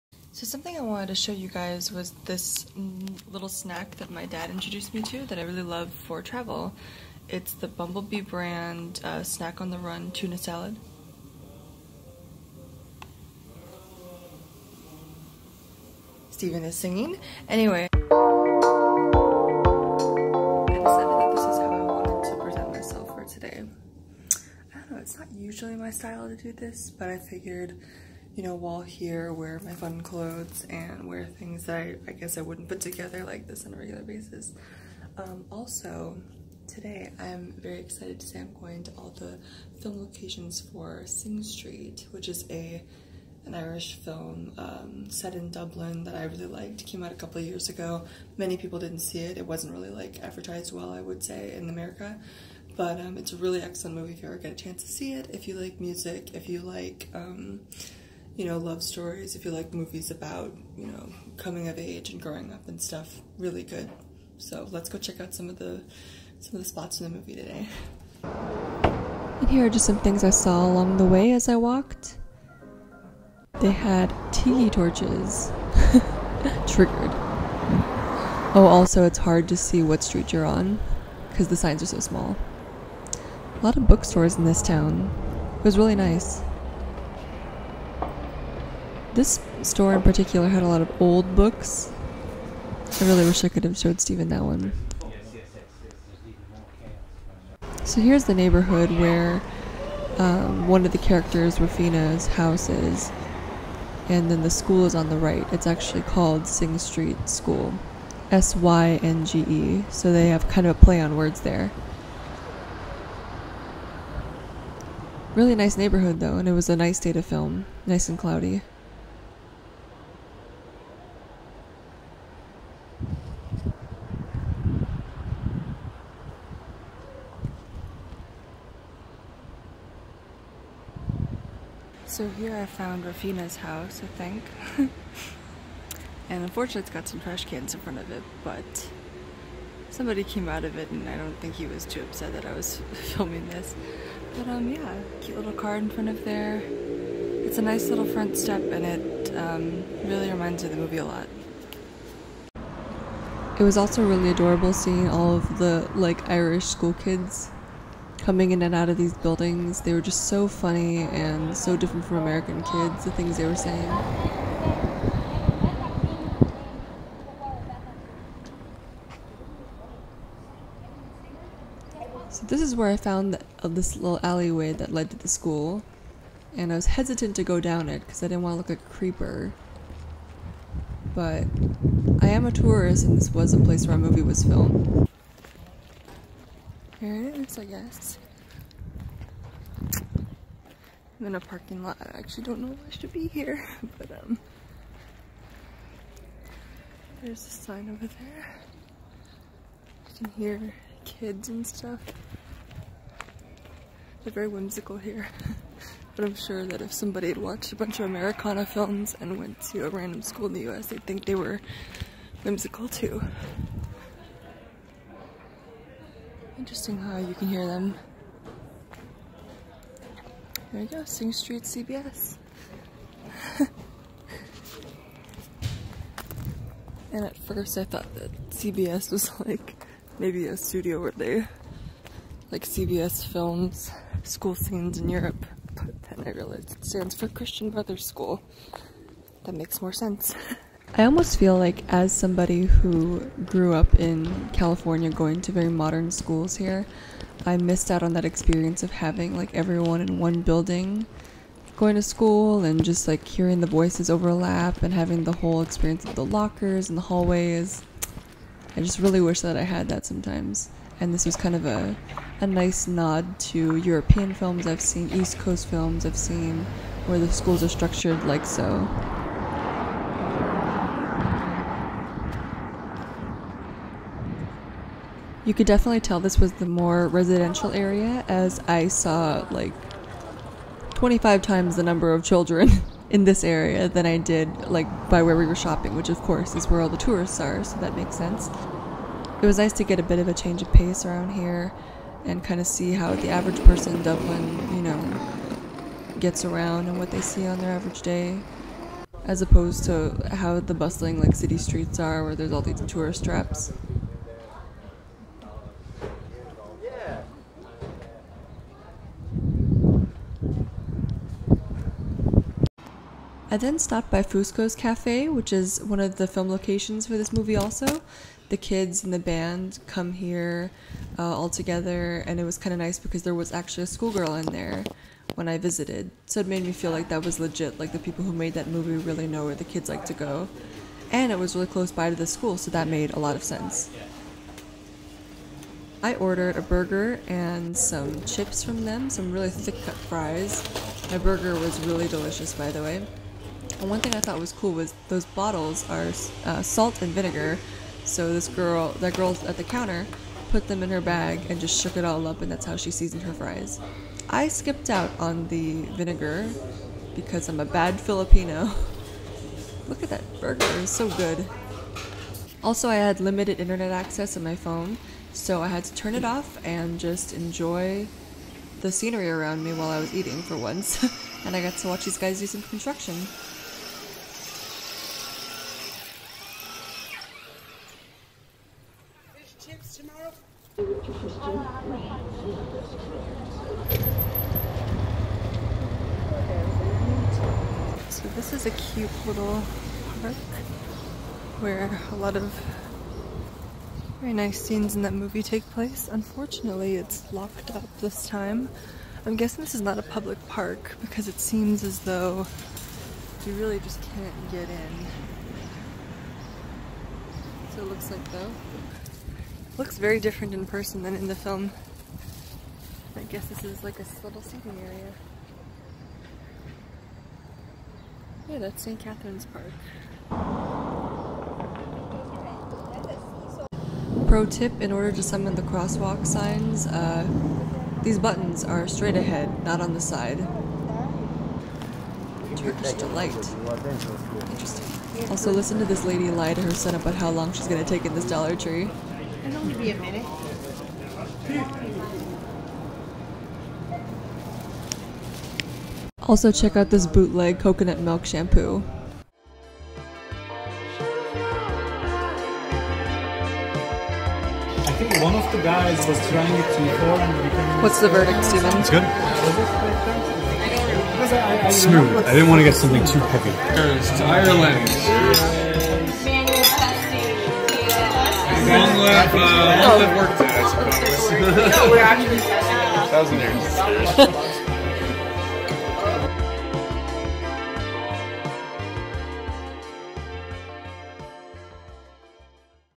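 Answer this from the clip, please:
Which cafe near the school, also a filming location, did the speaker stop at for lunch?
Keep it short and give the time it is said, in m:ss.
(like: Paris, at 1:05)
Fusco's Cafe, at 5:14.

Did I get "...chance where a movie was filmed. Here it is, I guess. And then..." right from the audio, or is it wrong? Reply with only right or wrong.
wrong.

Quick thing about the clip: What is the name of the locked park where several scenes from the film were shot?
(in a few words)
St. Catherine's Park.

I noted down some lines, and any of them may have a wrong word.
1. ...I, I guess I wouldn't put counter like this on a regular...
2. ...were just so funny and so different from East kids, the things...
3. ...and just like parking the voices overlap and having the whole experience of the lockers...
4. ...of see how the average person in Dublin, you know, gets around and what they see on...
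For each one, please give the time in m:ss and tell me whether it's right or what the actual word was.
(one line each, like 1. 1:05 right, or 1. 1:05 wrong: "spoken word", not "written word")
1. 0:31 wrong: "together", not "counter"
2. 2:39 wrong: "American", not "East"
3. 4:12 wrong: "hearing", not "parking"
4. 4:52 right.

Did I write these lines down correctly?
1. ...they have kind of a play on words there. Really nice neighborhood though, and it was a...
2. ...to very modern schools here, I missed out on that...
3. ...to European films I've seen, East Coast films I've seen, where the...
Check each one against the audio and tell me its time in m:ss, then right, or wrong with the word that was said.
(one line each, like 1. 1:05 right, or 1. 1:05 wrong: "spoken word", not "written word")
1. 1:50 right
2. 4:05 right
3. 4:23 right.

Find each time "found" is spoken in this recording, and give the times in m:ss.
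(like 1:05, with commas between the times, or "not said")
2:12, 2:52.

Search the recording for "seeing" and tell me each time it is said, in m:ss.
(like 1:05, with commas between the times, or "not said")
2:34.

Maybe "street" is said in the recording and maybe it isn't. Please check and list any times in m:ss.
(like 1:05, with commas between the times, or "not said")
0:41, 1:20, 1:46, 3:41, 5:01.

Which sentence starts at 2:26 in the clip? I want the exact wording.
It's a nice little front step and it um, really reminds me of the movie a lot.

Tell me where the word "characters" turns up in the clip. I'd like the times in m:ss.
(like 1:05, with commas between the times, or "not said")
1:40.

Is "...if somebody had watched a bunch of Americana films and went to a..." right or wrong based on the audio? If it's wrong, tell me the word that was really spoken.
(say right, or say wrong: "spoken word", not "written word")
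right.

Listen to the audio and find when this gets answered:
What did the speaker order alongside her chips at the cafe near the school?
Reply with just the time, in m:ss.
5:36.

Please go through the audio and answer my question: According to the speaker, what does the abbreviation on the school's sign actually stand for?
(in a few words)
Christian Brothers School.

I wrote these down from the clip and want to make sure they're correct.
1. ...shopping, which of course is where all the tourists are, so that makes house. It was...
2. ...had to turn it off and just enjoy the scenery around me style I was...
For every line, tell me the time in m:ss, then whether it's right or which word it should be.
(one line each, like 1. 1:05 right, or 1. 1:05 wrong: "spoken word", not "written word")
1. 4:45 wrong: "sense", not "house"
2. 6:05 wrong: "while", not "style".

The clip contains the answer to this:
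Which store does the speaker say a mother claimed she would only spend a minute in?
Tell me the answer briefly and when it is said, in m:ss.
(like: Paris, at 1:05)
Dollar Tree, at 7:18.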